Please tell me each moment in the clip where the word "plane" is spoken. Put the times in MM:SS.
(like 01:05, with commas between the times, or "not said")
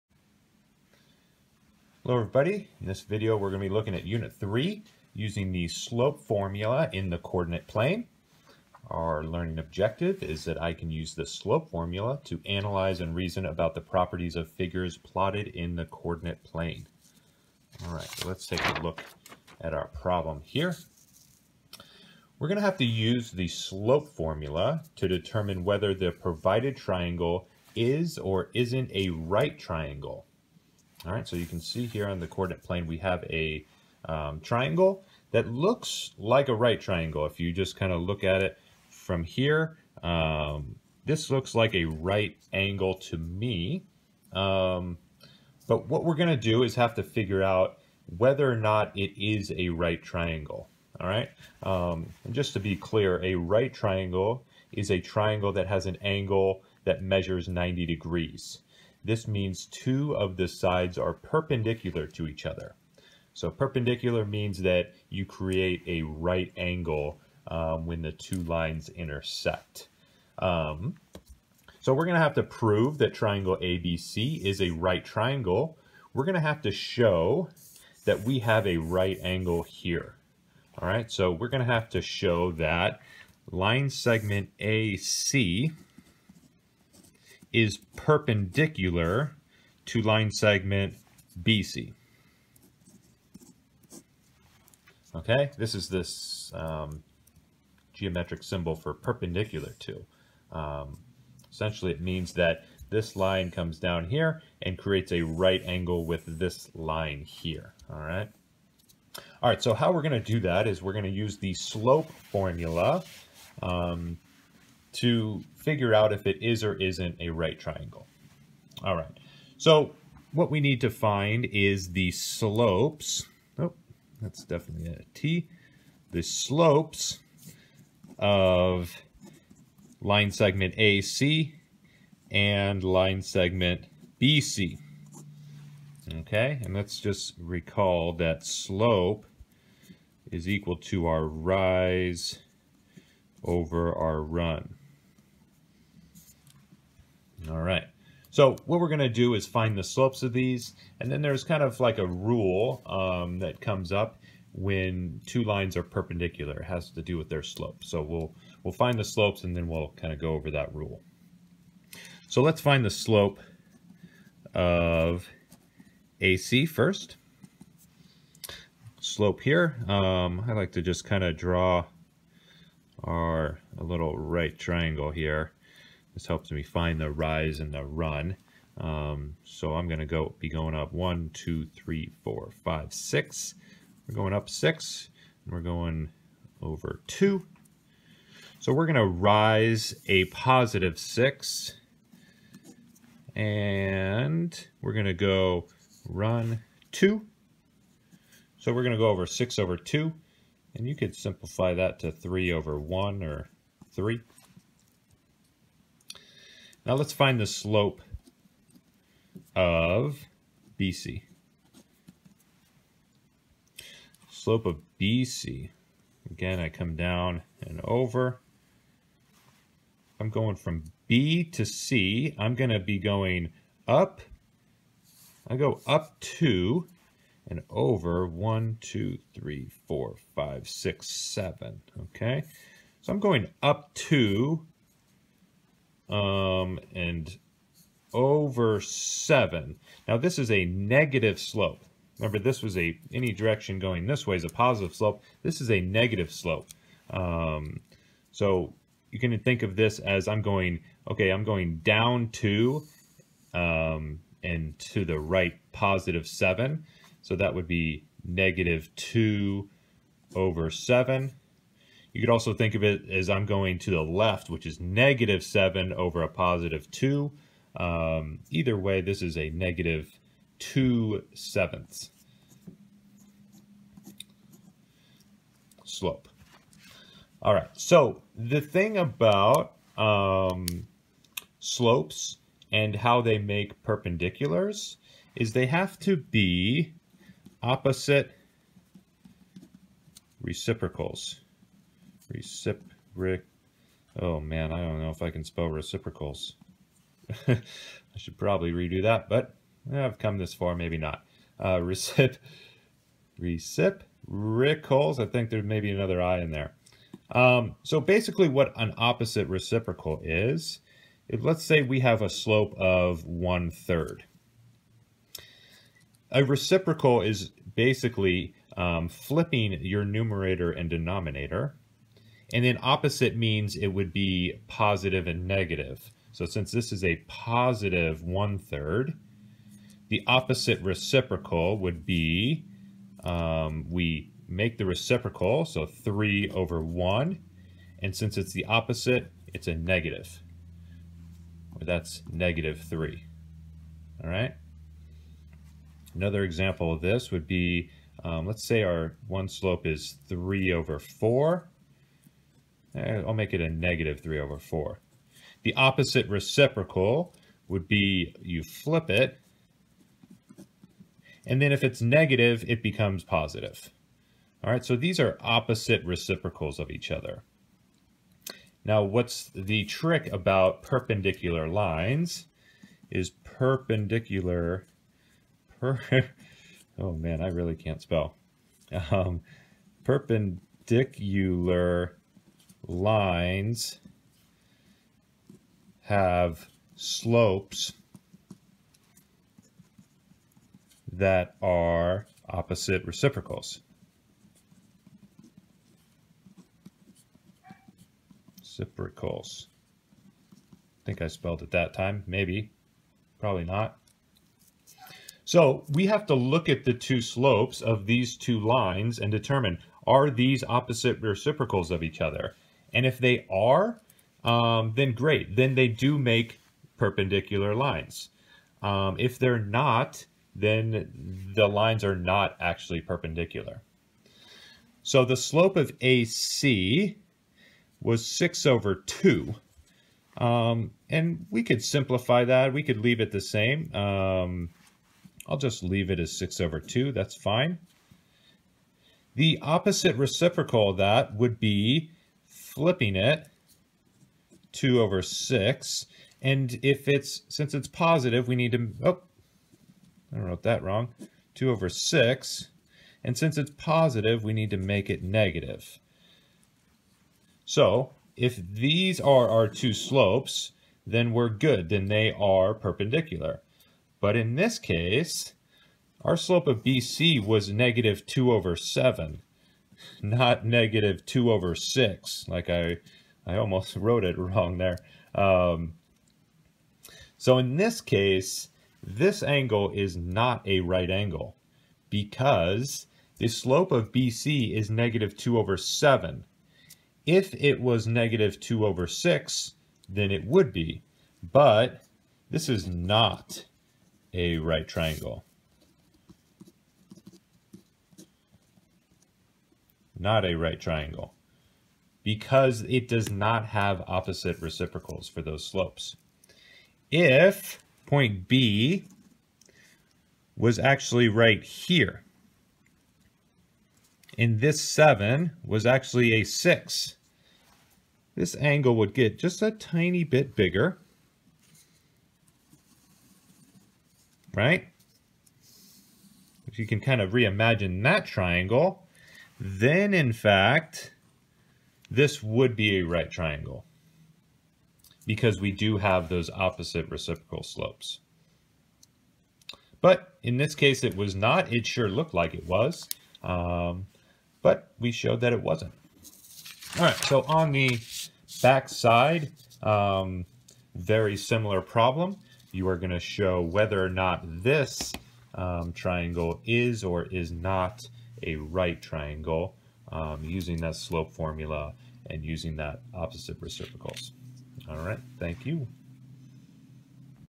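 00:07, 00:16, 00:32.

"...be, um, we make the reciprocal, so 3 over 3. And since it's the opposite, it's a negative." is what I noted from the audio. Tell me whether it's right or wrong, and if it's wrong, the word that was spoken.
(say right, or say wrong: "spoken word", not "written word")
wrong: "1", not "3".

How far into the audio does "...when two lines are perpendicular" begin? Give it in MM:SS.
02:34.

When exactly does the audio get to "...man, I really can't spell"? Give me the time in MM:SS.
06:17.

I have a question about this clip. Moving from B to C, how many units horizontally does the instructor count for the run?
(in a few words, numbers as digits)
7.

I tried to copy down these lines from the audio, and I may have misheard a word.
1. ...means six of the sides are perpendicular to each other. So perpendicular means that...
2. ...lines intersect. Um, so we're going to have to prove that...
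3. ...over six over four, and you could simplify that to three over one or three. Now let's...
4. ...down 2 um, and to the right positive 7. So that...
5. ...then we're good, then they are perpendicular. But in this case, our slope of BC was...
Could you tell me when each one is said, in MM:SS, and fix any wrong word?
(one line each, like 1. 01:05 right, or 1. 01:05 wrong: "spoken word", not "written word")
1. 00:59 wrong: "two", not "six"
2. 01:08 right
3. 03:19 wrong: "two", not "four"
4. 04:11 right
5. 07:41 right.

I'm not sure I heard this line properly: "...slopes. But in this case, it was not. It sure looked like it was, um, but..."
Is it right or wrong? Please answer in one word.
right.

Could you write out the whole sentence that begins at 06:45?
So we have to look at the two slopes of these two lines and determine, are these opposite reciprocals of each other?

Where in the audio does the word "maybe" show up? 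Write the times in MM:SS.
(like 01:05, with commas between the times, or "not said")
05:00, 06:42.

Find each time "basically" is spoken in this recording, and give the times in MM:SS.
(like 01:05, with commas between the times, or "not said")
05:08, 05:17.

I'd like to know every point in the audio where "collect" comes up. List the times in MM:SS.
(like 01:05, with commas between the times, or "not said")
not said.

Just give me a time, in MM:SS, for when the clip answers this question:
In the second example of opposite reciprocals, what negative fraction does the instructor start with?
05:53.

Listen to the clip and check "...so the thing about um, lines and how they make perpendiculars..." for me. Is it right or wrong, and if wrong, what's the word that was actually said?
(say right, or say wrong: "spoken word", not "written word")
wrong: "slopes", not "lines".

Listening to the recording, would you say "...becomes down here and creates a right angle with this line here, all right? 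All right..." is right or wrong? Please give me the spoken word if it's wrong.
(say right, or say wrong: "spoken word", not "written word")
wrong: "comes", not "becomes".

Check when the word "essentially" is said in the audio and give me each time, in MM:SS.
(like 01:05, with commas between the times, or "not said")
01:41.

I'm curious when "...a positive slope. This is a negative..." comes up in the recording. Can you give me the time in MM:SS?
04:04.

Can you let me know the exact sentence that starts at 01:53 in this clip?
Um, to figure out if it is or isn't a right triangle.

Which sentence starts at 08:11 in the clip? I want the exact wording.
But this is not a right triangle.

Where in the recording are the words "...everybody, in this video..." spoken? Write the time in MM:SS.
00:02.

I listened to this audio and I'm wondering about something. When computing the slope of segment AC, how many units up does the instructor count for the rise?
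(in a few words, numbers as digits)
6.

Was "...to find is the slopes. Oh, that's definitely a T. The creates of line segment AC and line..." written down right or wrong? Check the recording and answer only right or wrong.
wrong.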